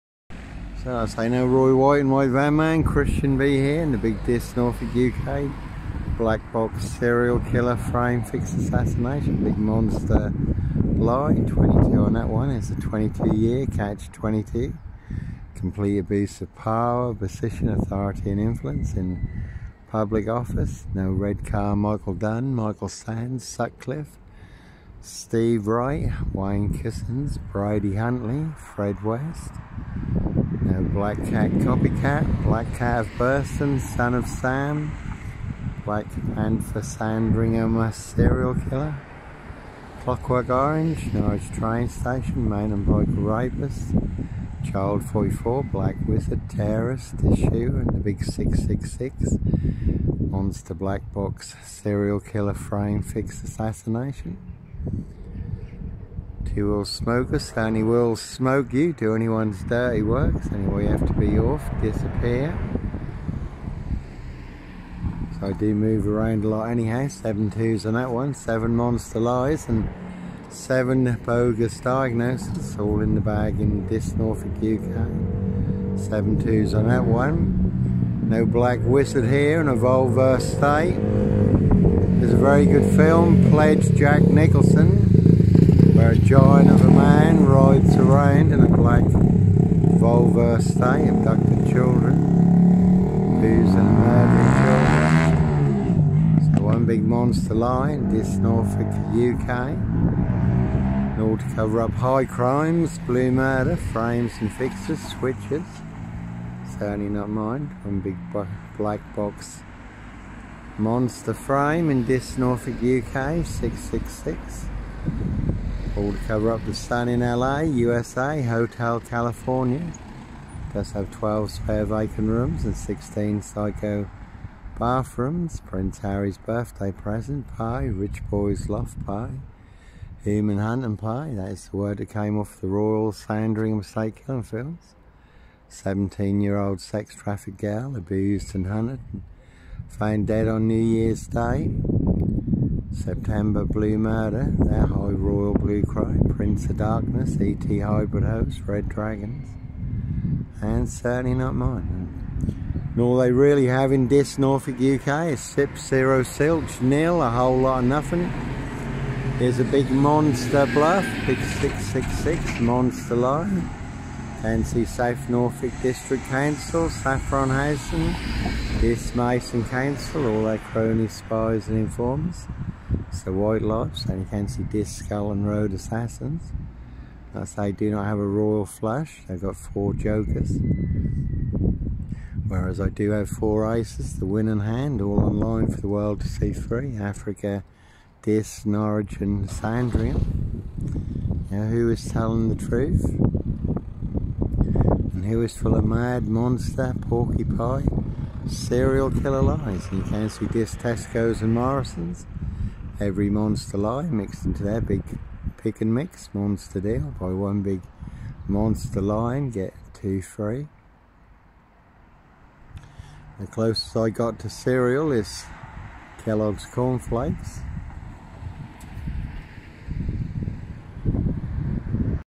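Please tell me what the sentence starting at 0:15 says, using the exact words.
Complete abuse of power, position, authority and influence in public office.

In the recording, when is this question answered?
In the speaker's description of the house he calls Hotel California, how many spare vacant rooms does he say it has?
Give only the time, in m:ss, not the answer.
2:01.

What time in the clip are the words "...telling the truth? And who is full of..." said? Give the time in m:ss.
3:12.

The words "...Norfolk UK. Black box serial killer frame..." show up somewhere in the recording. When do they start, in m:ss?
0:04.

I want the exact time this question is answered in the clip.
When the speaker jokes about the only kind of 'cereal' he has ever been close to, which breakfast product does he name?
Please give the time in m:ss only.
3:36.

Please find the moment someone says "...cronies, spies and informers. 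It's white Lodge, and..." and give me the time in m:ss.
2:50.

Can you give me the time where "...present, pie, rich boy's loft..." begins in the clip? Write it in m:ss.
2:06.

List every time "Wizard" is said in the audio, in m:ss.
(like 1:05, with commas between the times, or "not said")
0:46, 1:18.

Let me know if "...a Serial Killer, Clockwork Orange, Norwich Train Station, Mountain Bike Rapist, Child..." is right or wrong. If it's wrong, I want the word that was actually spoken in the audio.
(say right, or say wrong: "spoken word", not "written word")
right.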